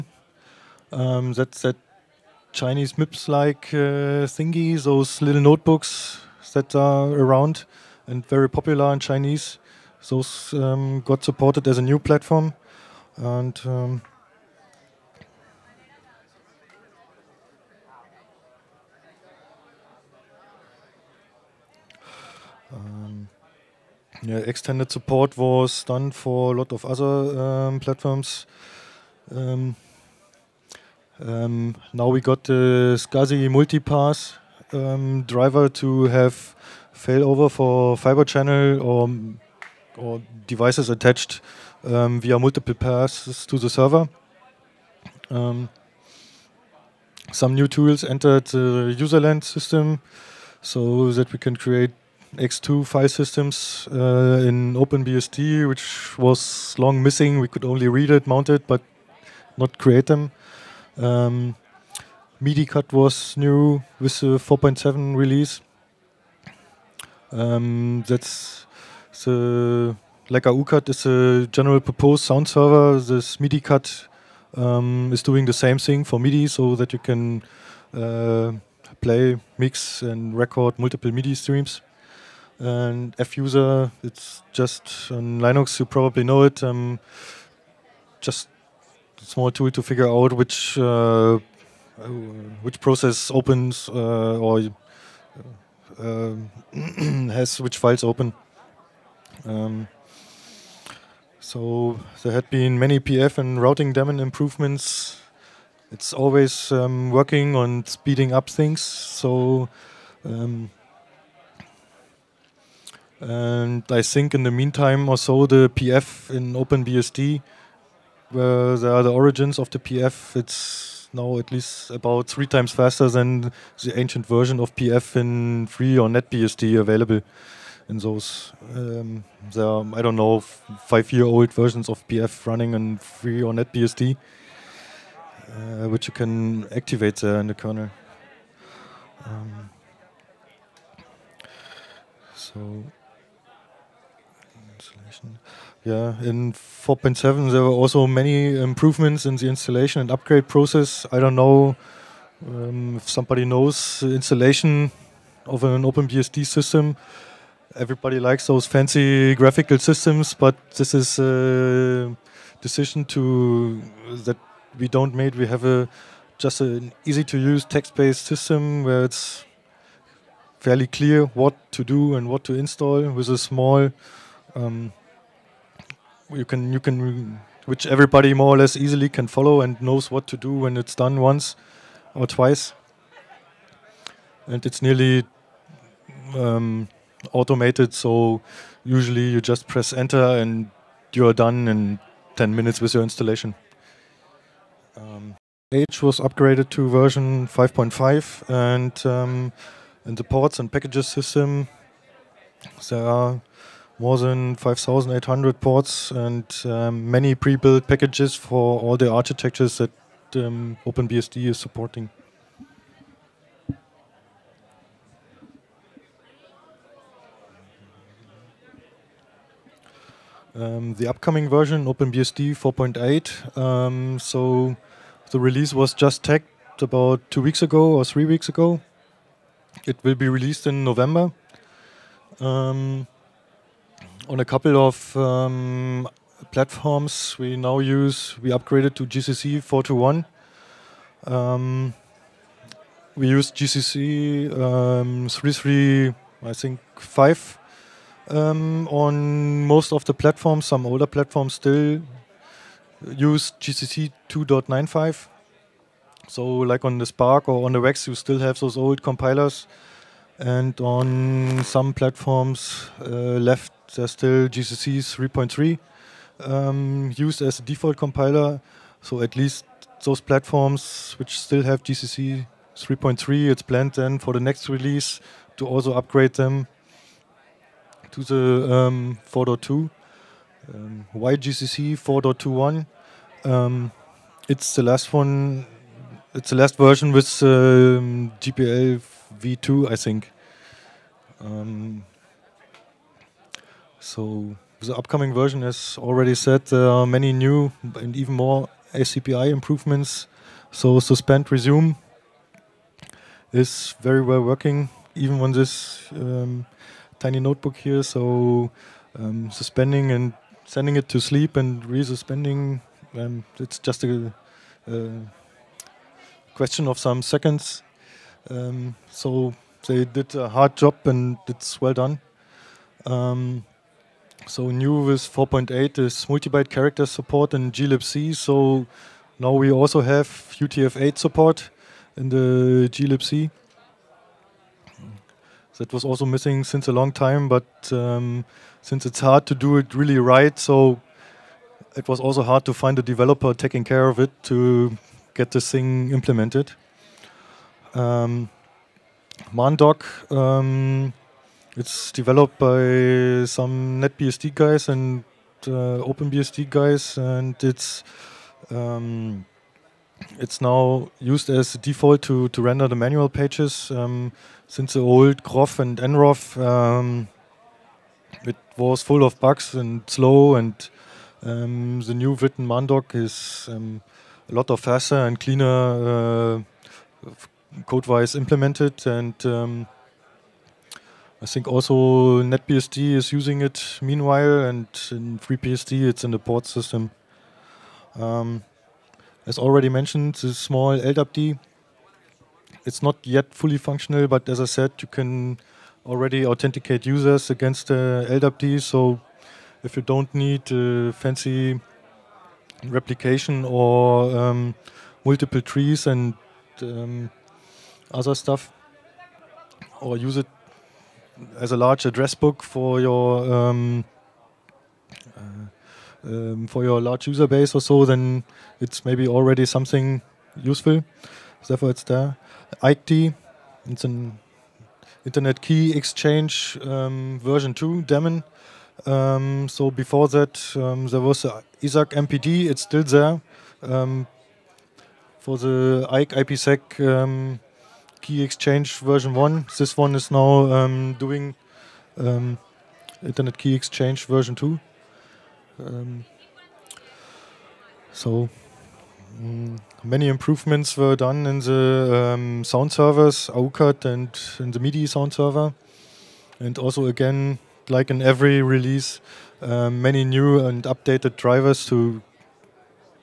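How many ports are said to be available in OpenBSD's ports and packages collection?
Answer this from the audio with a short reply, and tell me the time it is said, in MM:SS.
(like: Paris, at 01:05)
more than 5,800, at 03:24.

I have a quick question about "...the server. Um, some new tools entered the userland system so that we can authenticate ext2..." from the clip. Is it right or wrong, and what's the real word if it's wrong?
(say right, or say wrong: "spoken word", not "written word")
wrong: "create", not "authenticate".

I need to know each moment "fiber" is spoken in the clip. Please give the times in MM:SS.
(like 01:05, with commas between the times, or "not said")
00:37.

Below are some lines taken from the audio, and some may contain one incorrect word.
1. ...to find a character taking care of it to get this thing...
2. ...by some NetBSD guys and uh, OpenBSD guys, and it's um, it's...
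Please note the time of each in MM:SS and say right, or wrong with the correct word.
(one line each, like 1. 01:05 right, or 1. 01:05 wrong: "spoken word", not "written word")
1. 05:42 wrong: "developer", not "character"
2. 05:52 right.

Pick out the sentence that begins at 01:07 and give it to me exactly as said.
Um, that's the aucat is a general purpose sound server.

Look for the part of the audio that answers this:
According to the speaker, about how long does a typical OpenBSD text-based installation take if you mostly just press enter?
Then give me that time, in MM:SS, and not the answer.
03:12.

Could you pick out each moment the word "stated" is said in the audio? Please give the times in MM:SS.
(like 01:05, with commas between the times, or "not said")
not said.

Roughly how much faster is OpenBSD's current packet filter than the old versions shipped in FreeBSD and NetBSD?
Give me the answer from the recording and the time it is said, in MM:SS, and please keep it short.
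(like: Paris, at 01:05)
3 times, at 02:02.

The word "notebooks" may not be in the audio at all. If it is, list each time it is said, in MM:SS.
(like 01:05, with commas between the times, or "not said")
00:05, 05:07.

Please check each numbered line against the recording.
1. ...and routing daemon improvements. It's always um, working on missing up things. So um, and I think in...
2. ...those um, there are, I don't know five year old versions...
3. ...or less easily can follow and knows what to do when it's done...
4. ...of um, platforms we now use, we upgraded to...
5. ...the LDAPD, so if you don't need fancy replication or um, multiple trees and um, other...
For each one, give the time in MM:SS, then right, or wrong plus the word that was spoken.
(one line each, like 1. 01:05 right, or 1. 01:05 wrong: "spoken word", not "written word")
1. 01:43 wrong: "speeding", not "missing"
2. 02:07 right
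3. 02:58 right
4. 03:54 right
5. 06:37 right.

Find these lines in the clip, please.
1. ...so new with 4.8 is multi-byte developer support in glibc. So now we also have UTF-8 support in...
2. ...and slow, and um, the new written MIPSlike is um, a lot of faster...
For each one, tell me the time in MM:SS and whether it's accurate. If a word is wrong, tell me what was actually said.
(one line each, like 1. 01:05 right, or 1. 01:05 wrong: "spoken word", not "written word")
1. 05:24 wrong: "character", not "developer"
2. 06:09 wrong: "Mandoc", not "MIPSlike".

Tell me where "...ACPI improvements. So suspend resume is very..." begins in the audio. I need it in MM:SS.
04:58.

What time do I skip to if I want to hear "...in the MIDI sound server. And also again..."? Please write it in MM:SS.
07:34.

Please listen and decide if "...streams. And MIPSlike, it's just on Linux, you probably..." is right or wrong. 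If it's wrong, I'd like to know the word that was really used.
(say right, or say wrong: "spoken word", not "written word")
wrong: "Fuser", not "MIPSlike".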